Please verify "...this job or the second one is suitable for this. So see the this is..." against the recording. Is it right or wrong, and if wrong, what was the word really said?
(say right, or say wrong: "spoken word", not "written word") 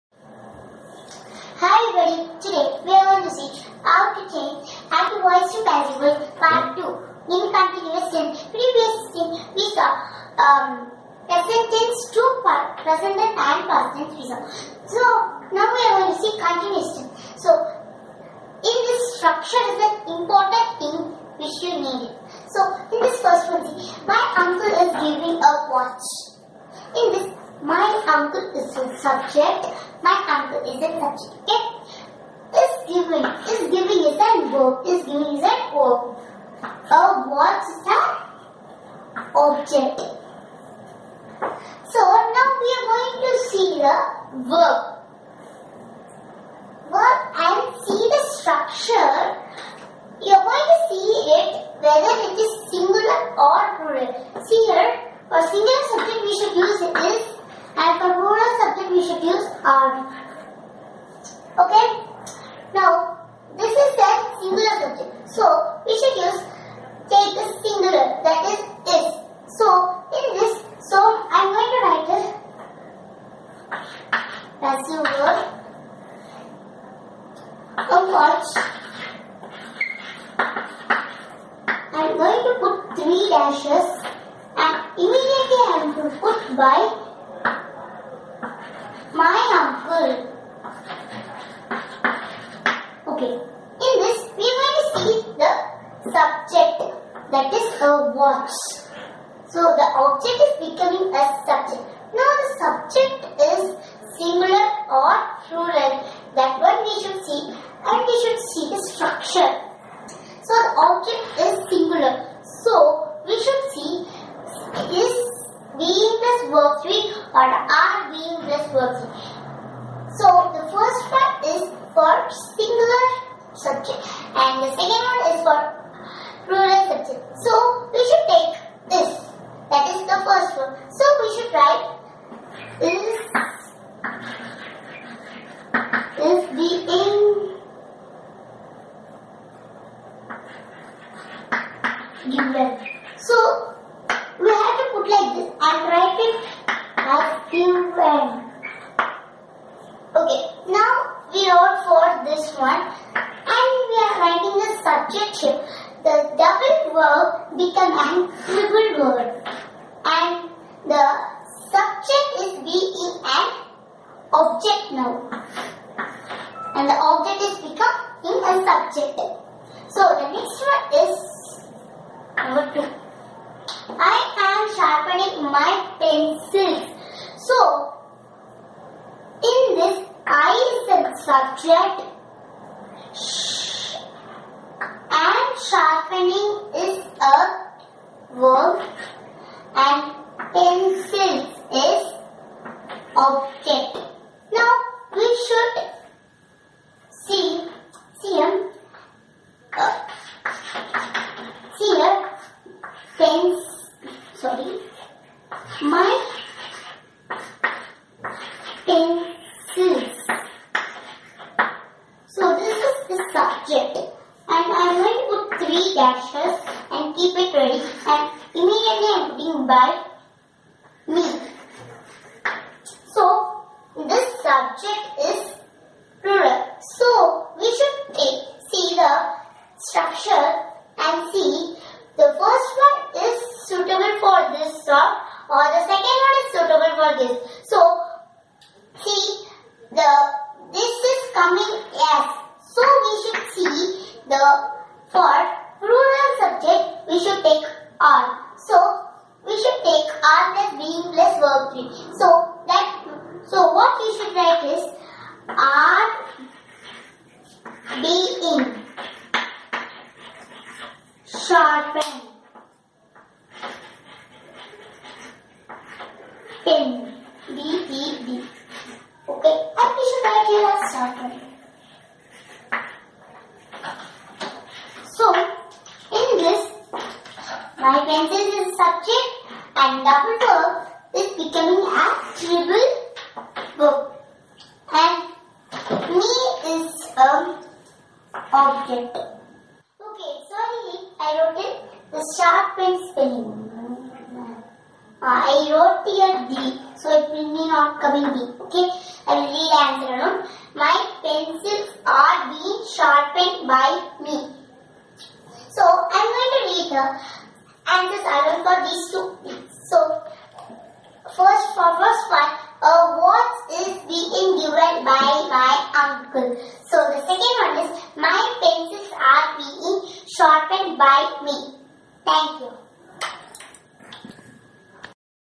right.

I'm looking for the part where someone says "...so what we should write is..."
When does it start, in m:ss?
4:13.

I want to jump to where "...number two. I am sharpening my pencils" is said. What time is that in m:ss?
2:52.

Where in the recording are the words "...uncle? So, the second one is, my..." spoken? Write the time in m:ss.
5:16.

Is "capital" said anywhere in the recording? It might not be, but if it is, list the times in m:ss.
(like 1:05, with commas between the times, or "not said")
not said.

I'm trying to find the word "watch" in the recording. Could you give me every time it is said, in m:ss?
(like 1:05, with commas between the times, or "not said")
0:25, 1:18, 1:38.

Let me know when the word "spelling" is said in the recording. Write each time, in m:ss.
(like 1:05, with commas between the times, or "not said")
4:53.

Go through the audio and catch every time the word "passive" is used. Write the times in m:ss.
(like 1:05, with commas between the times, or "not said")
0:05, 1:14.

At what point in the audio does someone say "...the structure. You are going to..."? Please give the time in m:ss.
0:48.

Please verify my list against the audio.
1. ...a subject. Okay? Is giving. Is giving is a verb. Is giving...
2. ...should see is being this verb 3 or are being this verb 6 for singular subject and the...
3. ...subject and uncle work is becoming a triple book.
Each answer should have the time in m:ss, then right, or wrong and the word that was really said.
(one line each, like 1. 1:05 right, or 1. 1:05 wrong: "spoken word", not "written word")
1. 0:30 right
2. 1:53 wrong: "3", not "6"
3. 4:38 wrong: "double", not "uncle".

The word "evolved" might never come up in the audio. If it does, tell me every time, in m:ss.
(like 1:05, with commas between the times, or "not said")
not said.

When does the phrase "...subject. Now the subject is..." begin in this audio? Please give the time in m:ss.
1:41.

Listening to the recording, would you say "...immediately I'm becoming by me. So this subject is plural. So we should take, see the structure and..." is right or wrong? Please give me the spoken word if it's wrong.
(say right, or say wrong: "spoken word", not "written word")
wrong: "putting", not "becoming".